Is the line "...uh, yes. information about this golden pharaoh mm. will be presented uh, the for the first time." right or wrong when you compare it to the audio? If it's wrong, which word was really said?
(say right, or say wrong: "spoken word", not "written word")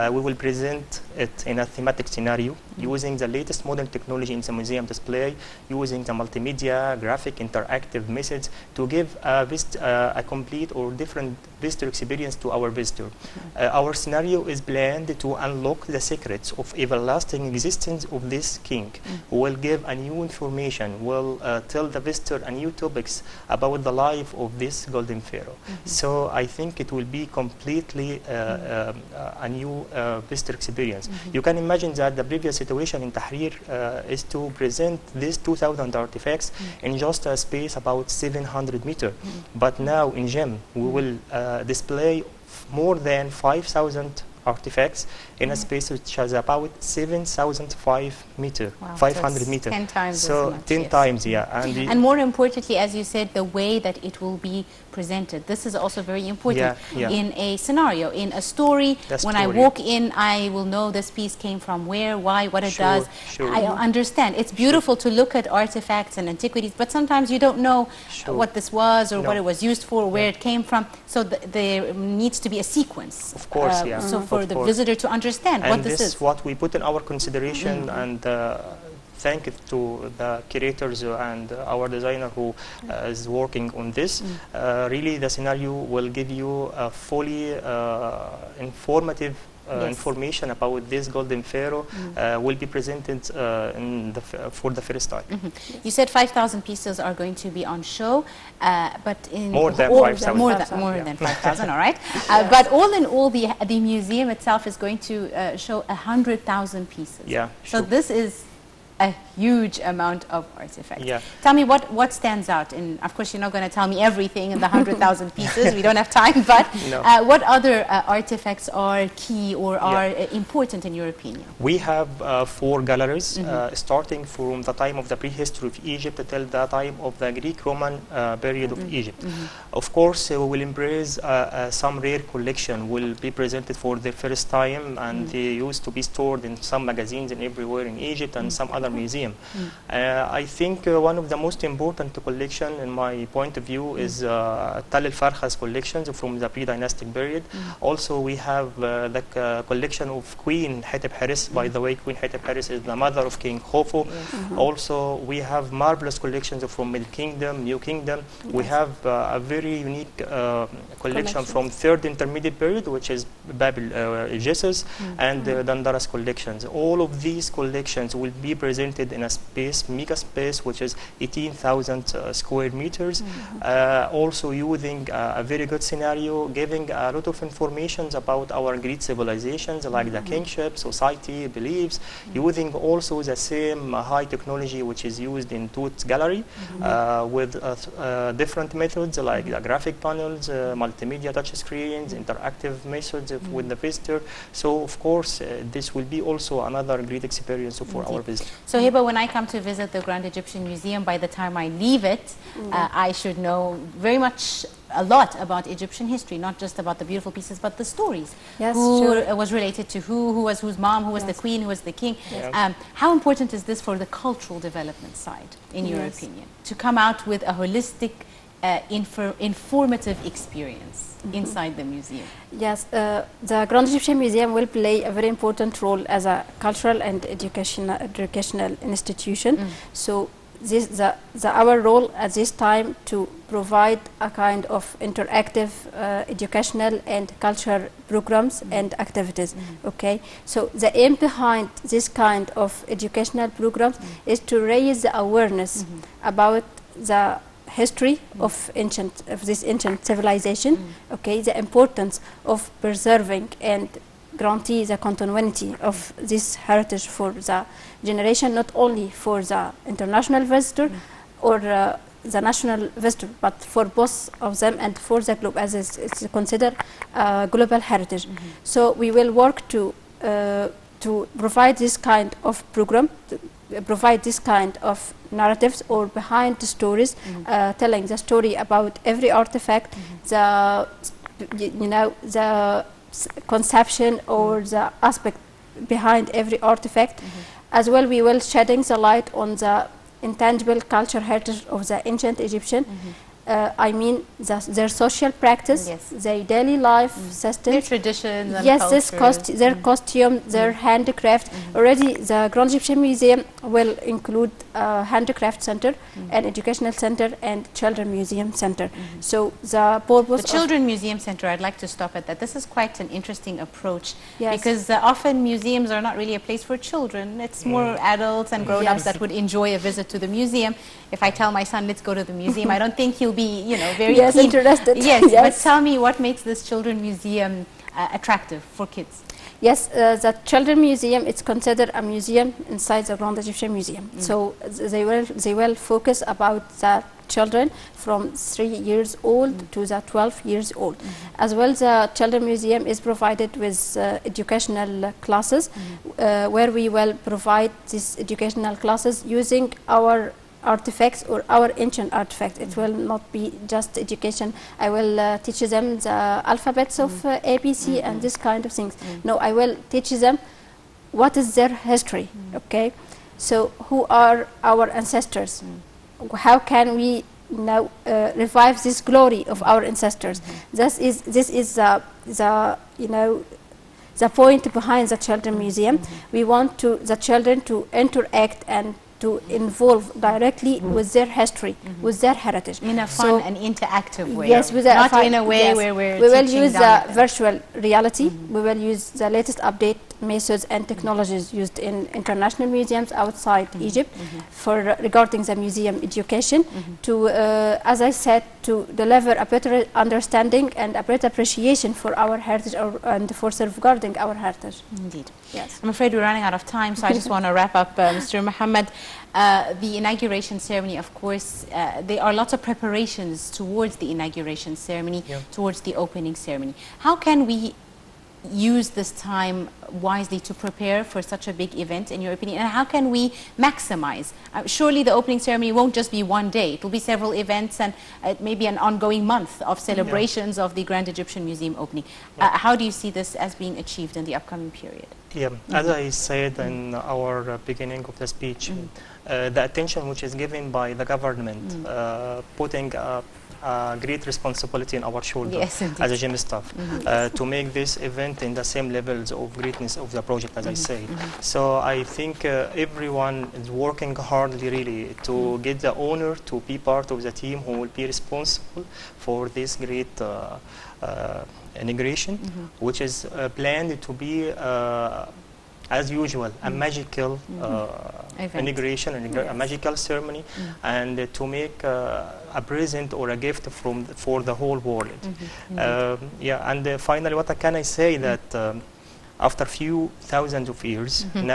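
right.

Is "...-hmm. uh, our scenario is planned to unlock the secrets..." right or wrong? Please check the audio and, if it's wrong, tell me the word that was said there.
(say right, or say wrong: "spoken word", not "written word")
right.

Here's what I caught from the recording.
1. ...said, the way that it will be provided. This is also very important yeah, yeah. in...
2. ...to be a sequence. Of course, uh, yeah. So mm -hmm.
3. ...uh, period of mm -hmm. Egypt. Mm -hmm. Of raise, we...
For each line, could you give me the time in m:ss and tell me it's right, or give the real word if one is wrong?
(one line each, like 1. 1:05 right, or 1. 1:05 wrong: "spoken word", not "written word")
1. 0:53 wrong: "presented", not "provided"
2. 1:12 right
3. 2:07 wrong: "course", not "raise".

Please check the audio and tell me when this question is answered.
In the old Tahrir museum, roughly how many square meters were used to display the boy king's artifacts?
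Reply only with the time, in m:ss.
0:38.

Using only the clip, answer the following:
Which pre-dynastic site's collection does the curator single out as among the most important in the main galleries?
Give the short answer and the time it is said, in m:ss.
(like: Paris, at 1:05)
Tell el-Farkha, at 2:24.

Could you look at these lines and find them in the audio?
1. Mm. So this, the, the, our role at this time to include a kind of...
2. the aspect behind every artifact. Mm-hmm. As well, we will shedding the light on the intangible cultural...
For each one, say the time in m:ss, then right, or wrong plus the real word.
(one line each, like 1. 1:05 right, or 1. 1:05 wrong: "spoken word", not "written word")
1. 3:49 wrong: "provide", not "include"
2. 4:44 right.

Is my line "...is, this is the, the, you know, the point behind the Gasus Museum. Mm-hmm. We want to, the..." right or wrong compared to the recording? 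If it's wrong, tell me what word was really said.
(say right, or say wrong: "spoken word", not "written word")
wrong: "Children", not "Gasus".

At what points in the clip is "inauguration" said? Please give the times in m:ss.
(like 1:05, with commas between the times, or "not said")
6:49, 6:54.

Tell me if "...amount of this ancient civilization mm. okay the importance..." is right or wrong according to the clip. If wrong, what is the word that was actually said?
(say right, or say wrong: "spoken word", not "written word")
wrong: "ancient", not "amount".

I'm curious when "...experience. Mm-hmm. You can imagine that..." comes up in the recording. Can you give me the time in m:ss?
0:30.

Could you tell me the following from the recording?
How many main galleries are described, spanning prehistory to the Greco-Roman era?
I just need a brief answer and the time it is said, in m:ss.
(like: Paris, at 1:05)
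4, at 2:02.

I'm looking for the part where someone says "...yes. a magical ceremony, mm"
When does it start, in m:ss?
7:49.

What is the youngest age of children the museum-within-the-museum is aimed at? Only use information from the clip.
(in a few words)
3.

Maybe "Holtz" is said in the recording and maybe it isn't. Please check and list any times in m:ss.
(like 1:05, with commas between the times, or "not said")
not said.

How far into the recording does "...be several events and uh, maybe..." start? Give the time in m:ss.
7:06.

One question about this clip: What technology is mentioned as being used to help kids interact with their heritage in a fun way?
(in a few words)
virtual reality.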